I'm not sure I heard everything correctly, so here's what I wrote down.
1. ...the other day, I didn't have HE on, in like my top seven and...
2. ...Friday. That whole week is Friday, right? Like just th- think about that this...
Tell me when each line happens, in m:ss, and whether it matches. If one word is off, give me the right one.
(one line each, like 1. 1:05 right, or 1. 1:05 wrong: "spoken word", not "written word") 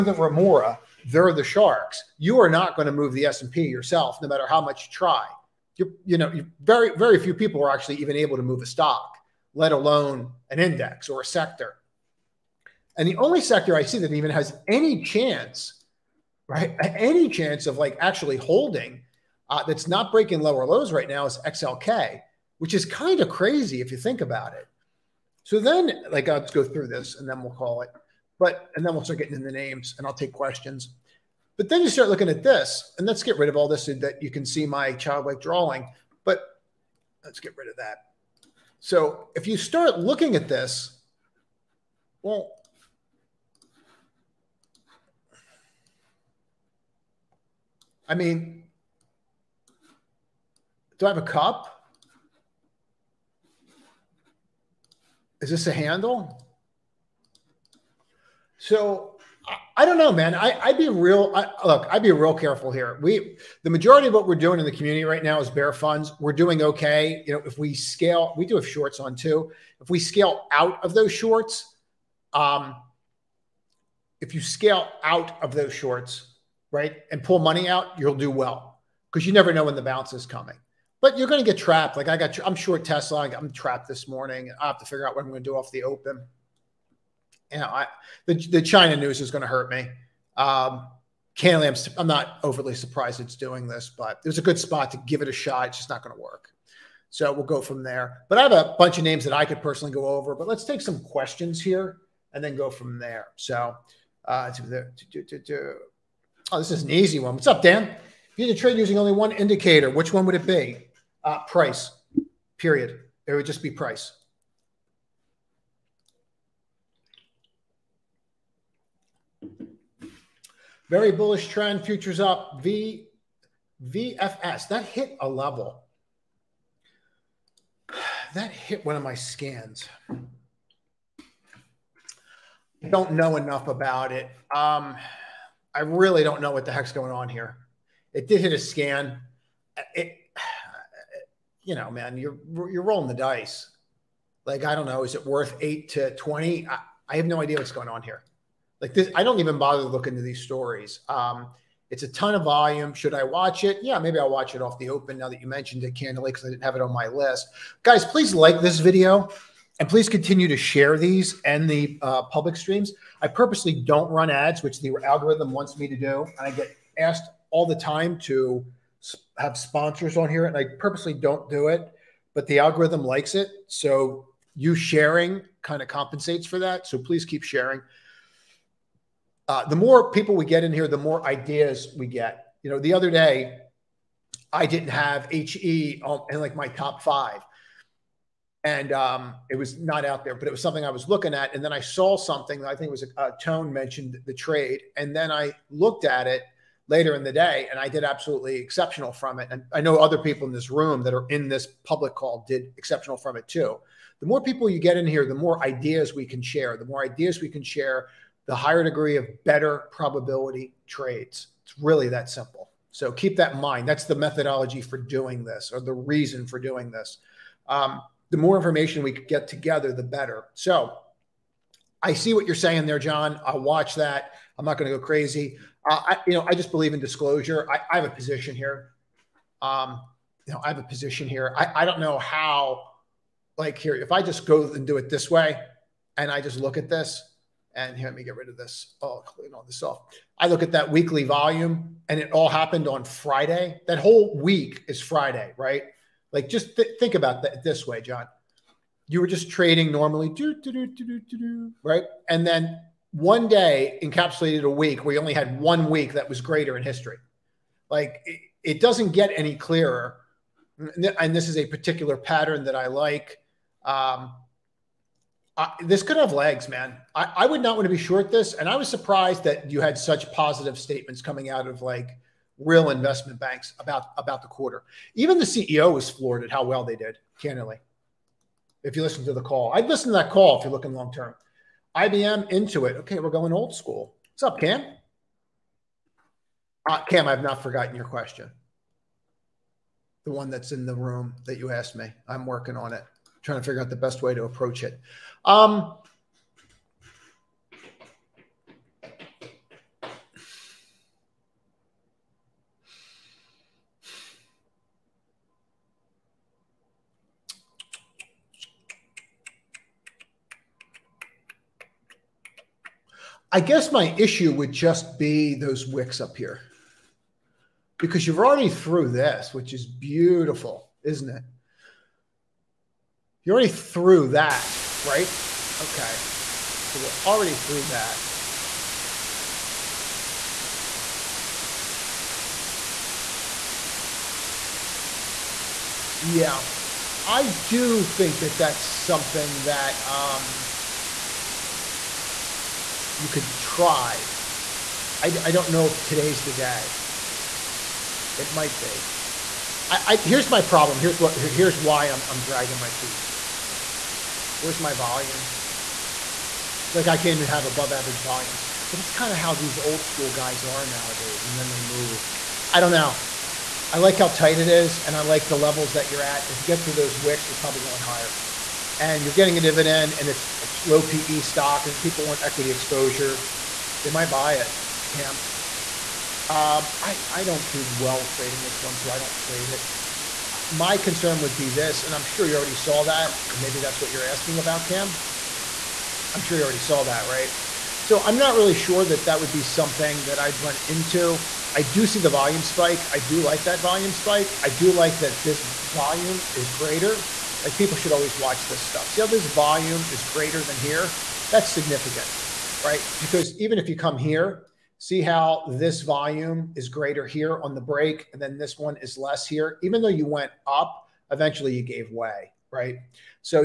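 1. 3:02 wrong: "five", not "seven"
2. 4:03 right.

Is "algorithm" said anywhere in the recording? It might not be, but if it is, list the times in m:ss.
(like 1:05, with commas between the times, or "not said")
2:45, 2:52.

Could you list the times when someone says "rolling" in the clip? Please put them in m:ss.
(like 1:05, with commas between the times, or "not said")
2:22.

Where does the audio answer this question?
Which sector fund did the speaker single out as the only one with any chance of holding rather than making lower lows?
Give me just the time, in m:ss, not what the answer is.
0:21.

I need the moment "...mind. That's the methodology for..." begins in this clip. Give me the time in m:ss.
3:33.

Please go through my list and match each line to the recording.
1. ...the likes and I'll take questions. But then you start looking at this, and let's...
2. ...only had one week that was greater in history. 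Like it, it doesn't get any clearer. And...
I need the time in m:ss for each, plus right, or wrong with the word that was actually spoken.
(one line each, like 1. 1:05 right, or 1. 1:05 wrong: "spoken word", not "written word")
1. 0:29 wrong: "names", not "likes"
2. 4:15 right.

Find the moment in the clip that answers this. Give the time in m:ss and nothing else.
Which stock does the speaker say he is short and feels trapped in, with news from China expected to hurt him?
1:22.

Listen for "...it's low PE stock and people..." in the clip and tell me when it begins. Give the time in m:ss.
6:10.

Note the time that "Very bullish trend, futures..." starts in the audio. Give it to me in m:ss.
2:00.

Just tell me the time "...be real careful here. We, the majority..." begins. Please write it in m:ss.
1:02.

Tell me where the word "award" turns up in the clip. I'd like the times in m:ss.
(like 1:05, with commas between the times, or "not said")
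not said.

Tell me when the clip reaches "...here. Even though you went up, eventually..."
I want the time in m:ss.
6:49.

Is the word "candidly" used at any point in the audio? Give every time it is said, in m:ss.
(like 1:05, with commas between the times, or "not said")
1:31, 2:35, 4:37.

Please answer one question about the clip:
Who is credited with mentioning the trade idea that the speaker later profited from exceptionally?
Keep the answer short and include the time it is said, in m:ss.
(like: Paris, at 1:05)
Tone, at 3:13.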